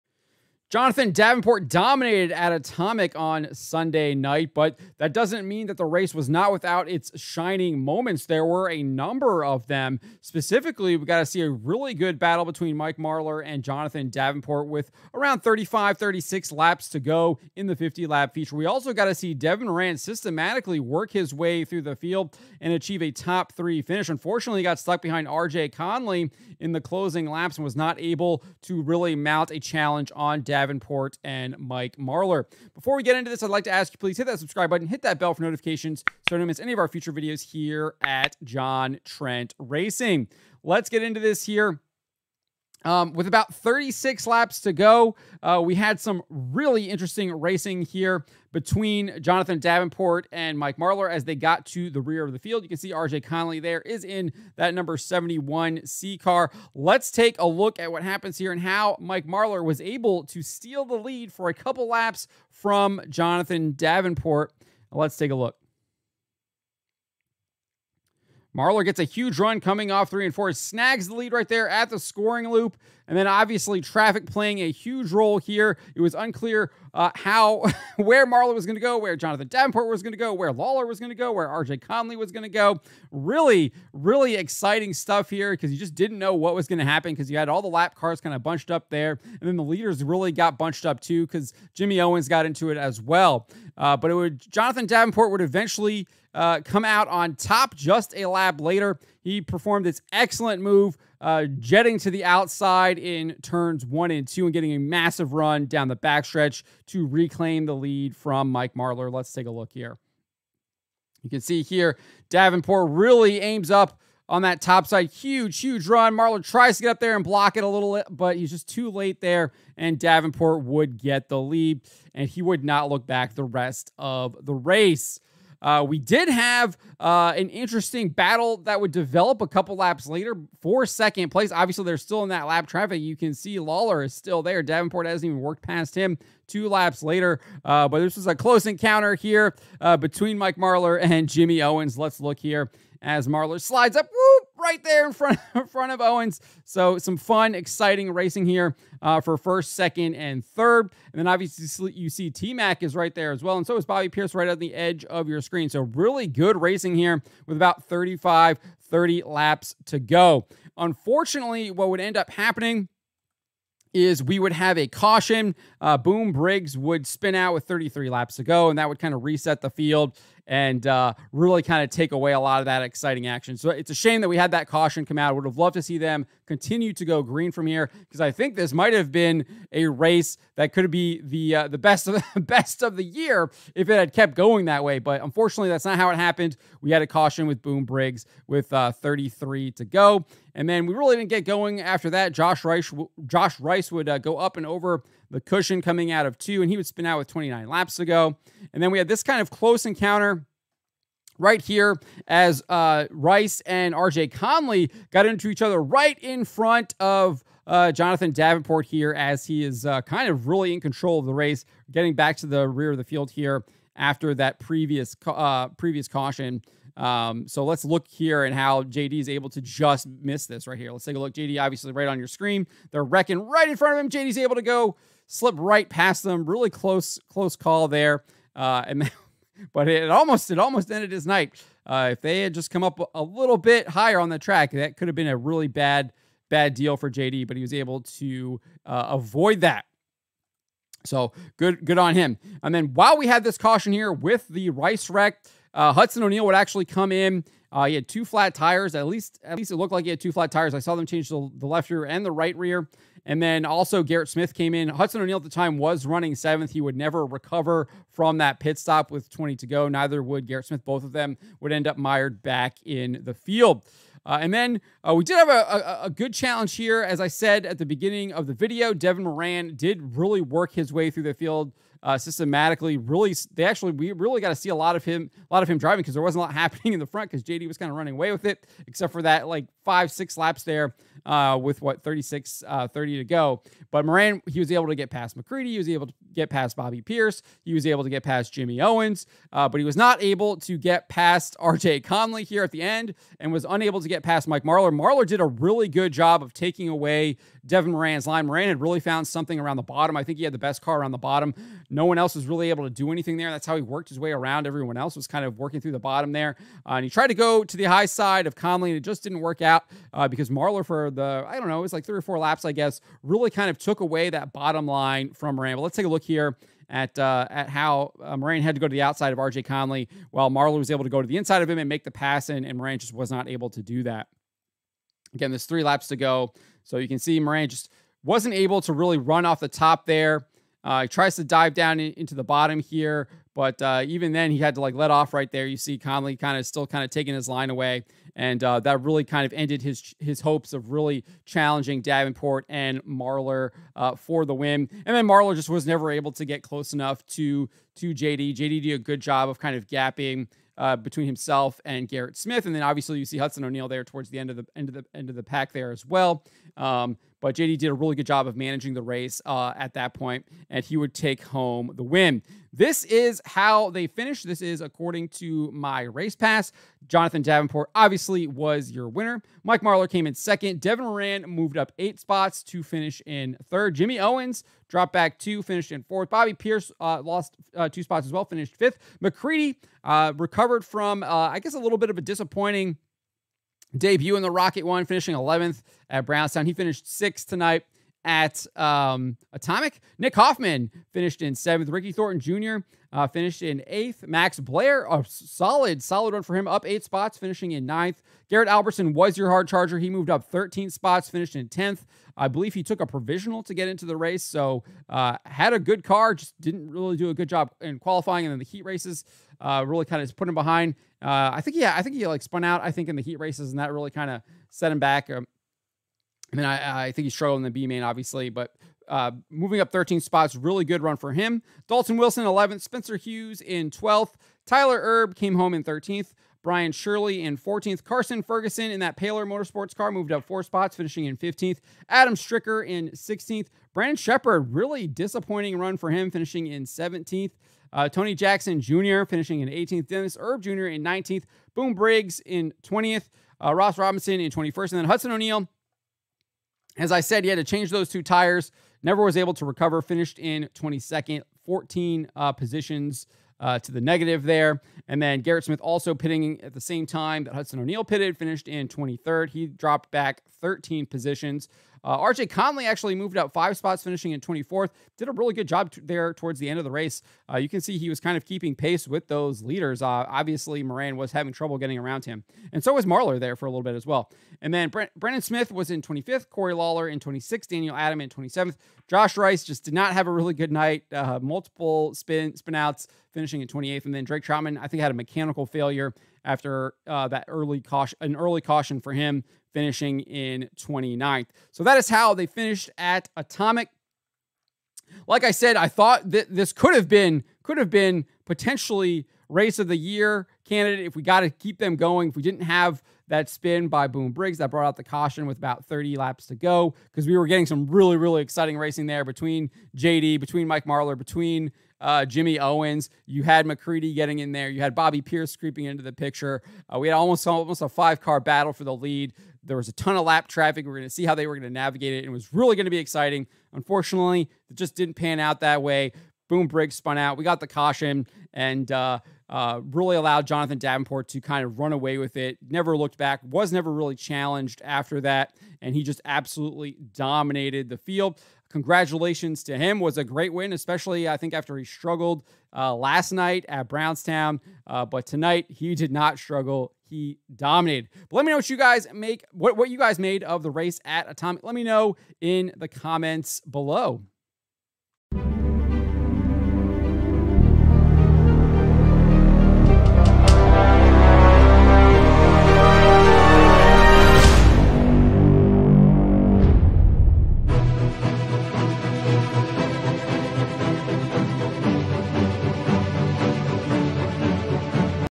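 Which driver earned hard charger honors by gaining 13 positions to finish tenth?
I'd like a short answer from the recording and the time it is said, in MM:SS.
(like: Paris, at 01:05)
Garrett Alberson, at 06:38.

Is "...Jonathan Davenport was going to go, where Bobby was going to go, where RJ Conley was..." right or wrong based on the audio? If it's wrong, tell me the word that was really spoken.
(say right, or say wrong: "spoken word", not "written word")
wrong: "Lawler", not "Bobby".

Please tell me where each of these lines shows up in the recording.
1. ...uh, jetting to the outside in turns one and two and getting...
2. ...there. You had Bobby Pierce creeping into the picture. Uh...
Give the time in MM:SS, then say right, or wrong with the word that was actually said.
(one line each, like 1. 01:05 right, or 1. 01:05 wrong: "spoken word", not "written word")
1. 01:41 right
2. 08:34 right.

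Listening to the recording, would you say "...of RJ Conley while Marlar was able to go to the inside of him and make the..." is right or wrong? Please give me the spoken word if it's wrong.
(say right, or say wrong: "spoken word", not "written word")
right.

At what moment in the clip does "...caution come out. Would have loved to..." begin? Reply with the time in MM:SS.
02:54.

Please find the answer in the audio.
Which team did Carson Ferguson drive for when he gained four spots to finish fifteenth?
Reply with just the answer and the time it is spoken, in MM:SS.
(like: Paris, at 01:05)
Paler Motorsports, at 07:09.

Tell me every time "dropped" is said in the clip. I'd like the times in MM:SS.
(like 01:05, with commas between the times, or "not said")
06:14, 07:39.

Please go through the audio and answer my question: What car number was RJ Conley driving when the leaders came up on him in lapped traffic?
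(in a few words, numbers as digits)
71 C.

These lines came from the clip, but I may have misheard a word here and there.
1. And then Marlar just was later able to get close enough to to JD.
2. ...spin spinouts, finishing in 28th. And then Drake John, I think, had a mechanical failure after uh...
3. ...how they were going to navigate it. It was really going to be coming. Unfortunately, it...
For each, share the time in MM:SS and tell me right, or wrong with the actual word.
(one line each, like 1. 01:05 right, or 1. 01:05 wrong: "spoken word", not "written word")
1. 05:45 wrong: "never", not "later"
2. 08:02 wrong: "Troutman", not "John"
3. 08:41 wrong: "exciting", not "coming".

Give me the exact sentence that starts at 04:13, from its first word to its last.
And then also Garrett Smith came in.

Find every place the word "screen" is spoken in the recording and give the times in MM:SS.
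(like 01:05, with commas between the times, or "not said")
02:35, 03:42.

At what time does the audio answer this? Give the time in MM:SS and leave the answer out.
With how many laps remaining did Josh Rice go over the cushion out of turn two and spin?
03:17.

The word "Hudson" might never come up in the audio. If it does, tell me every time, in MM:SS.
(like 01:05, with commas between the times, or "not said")
04:05, 04:14, 05:53, 07:25, 07:37.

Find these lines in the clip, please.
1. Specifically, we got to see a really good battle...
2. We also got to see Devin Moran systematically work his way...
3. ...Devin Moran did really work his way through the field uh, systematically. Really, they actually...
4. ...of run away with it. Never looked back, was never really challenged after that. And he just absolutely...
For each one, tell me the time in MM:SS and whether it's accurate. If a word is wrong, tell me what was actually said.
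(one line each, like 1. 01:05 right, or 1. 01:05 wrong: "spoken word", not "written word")
1. 00:10 right
2. 00:18 right
3. 04:28 right
4. 08:51 right.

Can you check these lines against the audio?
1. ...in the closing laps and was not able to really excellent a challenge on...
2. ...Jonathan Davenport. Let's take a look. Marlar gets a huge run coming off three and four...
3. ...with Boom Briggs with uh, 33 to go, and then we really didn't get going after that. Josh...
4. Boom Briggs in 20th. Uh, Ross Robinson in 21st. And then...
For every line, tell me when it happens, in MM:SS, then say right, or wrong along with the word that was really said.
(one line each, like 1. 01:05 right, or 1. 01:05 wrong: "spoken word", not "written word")
1. 00:26 wrong: "mount", not "excellent"
2. 01:03 right
3. 03:07 right
4. 07:21 right.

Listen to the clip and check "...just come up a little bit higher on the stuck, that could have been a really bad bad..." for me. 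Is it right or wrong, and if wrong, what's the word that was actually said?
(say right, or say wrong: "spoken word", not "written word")
wrong: "track", not "stuck".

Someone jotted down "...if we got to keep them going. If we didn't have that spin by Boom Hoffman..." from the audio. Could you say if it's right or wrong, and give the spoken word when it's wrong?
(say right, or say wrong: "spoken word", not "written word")
wrong: "Briggs", not "Hoffman".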